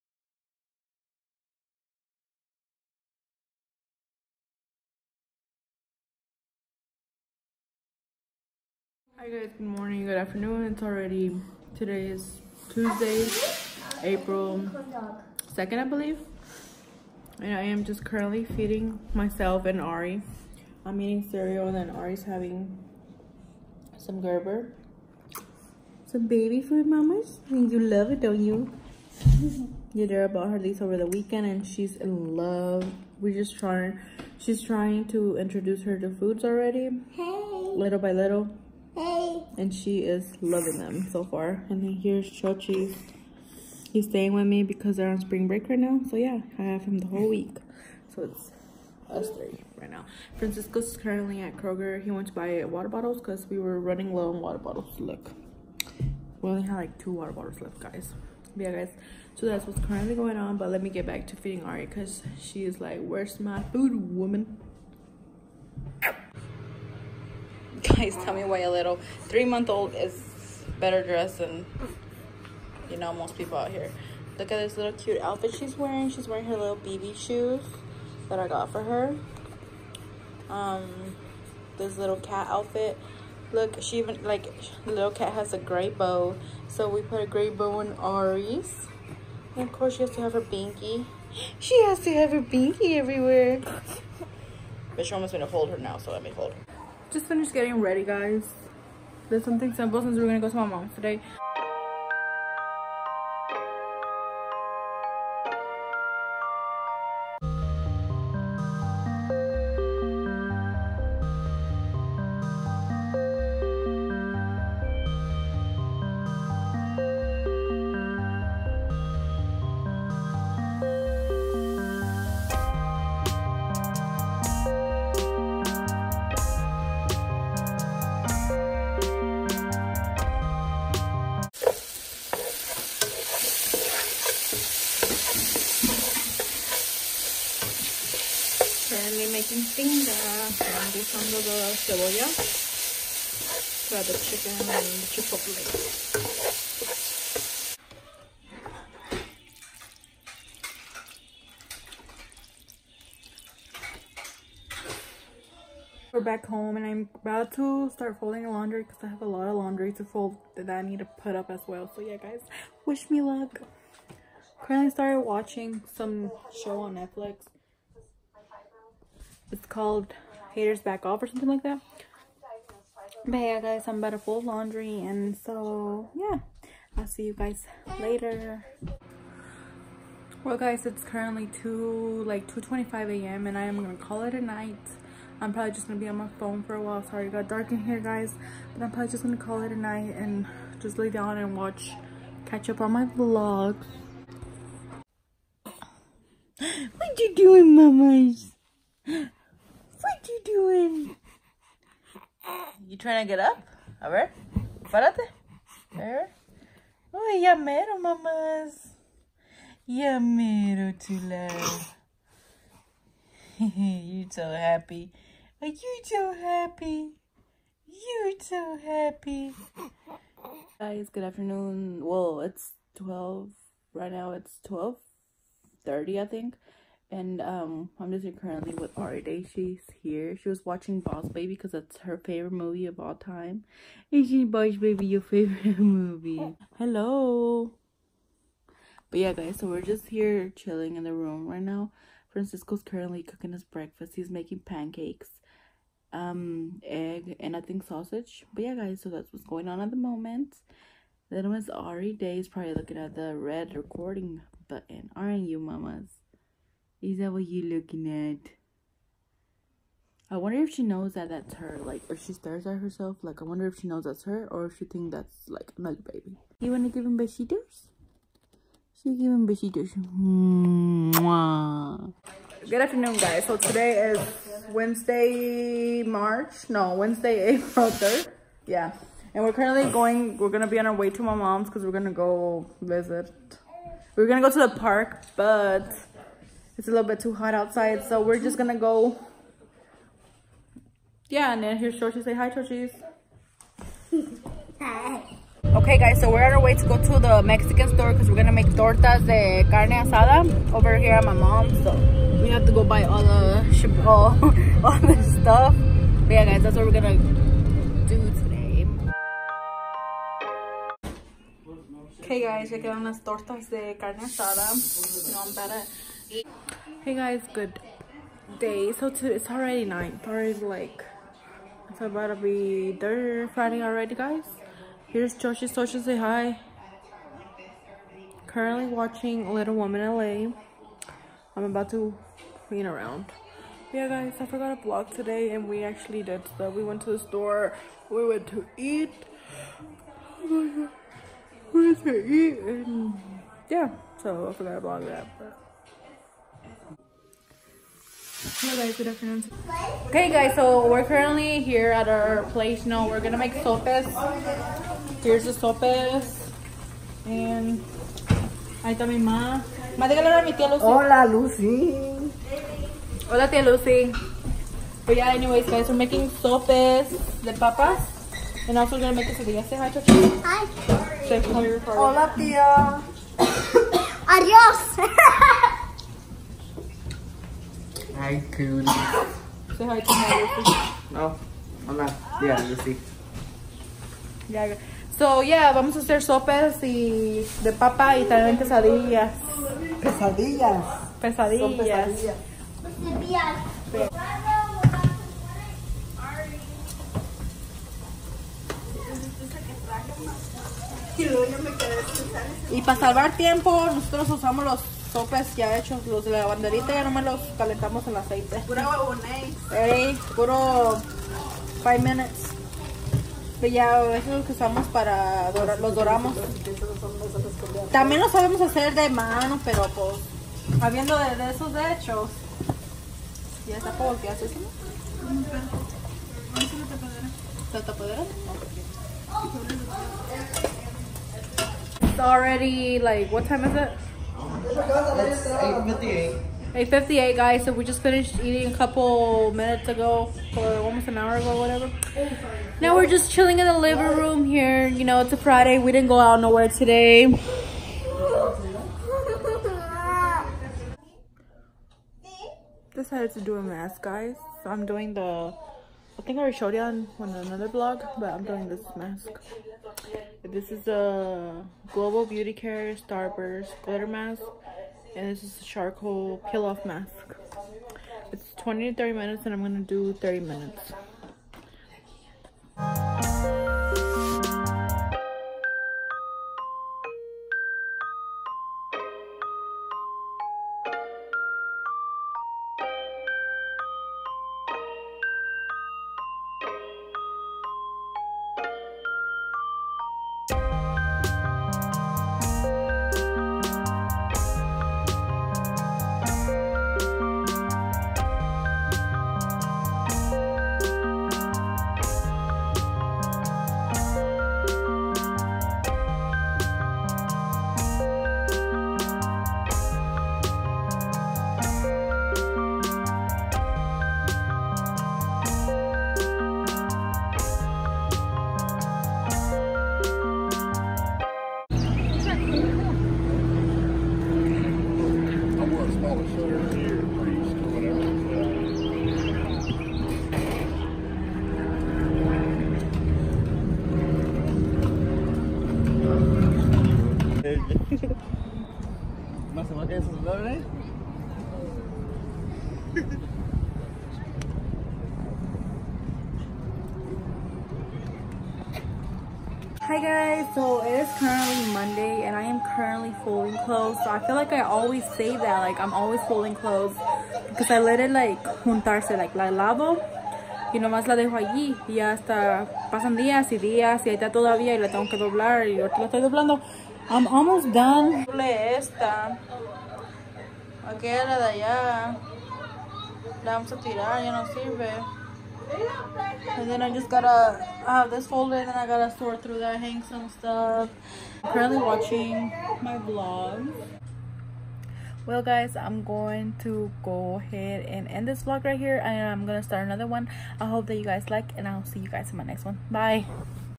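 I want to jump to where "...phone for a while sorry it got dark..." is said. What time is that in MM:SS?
03:06.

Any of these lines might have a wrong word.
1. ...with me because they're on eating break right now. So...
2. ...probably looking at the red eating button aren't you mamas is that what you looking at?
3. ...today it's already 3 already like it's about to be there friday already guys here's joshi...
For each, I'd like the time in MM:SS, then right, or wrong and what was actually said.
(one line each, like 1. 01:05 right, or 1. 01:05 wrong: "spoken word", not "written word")
1. 00:44 wrong: "spring", not "eating"
2. 04:12 wrong: "recording", not "eating"
3. 05:19 wrong: "9", not "3".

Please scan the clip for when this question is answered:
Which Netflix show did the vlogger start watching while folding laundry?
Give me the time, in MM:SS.
02:50.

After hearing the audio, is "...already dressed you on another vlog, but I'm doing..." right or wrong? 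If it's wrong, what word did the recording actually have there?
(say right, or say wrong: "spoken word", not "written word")
wrong: "showed", not "dressed".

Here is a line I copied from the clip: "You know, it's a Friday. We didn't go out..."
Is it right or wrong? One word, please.
right.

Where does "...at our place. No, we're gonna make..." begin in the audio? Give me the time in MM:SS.
05:51.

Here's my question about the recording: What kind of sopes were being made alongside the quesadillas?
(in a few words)
sopes de papas.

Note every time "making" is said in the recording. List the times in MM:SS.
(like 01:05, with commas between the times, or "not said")
04:04, 06:05.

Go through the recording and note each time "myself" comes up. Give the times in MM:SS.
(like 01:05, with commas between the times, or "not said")
00:19.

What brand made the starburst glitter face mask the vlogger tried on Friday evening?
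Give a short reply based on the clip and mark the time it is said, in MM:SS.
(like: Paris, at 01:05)
Global Beauty Care, at 07:41.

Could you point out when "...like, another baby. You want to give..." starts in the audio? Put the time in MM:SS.
04:25.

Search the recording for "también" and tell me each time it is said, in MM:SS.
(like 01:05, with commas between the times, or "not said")
06:28, 06:57.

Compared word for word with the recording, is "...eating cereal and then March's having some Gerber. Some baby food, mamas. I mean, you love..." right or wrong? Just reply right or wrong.
wrong.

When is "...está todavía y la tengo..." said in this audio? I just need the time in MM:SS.
09:24.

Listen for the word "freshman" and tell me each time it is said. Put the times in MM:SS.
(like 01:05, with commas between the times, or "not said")
not said.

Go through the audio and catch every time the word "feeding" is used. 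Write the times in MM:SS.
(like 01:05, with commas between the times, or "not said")
00:18, 01:01.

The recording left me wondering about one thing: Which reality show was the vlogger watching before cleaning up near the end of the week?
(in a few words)
Little Women LA.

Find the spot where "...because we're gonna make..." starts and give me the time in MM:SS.
04:58.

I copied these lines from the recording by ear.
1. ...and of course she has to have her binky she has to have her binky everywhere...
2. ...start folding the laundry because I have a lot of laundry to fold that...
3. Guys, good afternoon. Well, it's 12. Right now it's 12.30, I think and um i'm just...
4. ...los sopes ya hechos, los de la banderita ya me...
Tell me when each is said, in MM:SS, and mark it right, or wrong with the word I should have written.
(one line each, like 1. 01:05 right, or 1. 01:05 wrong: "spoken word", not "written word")
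1. 01:29 right
2. 02:37 right
3. 03:40 right
4. 06:44 right.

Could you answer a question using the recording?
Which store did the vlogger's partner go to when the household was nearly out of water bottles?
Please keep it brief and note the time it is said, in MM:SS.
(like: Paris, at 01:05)
Kroger, at 00:51.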